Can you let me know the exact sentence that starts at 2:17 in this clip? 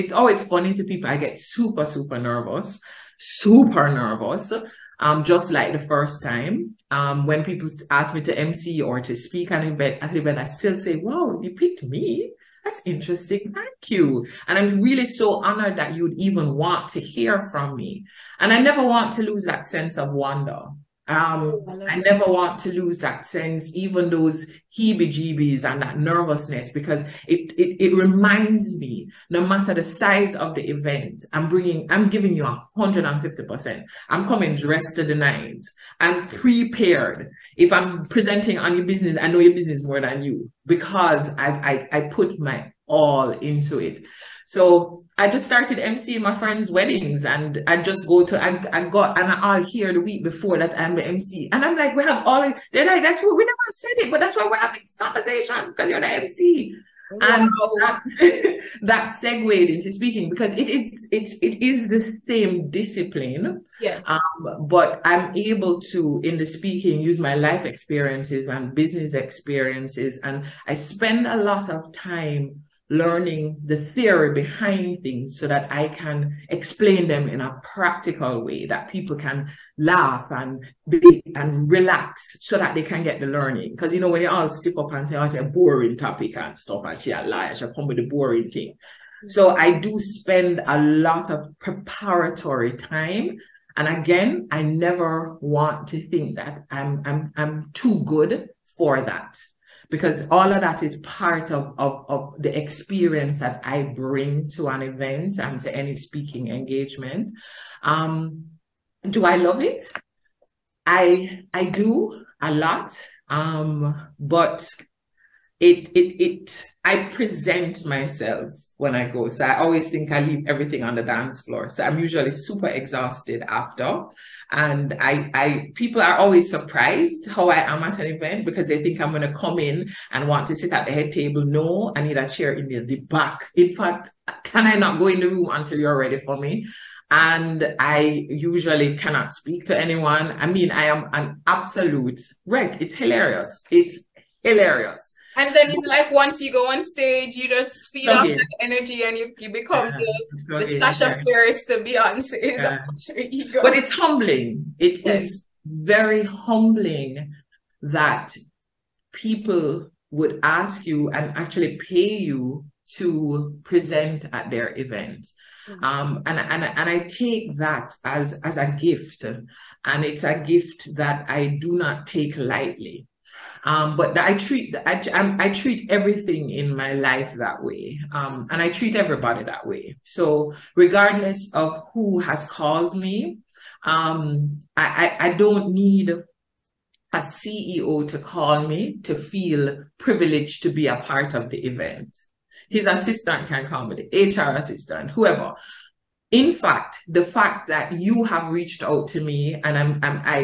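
and I usually cannot speak to anyone.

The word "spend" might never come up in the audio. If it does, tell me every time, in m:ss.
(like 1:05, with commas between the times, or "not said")
1:10, 1:29.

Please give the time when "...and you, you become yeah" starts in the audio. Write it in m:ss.
2:29.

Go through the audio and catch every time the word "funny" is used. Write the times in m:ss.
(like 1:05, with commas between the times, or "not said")
0:00.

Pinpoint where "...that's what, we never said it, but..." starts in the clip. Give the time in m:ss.
0:53.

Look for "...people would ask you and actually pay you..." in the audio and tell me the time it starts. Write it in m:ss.
2:39.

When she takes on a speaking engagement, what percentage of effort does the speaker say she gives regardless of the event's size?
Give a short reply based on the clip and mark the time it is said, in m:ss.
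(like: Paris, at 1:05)
150%, at 0:32.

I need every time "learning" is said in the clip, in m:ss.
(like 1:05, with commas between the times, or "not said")
1:12, 1:23.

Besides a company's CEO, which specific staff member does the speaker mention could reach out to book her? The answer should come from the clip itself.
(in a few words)
HR assistant.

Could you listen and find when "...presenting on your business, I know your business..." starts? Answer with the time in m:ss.
0:38.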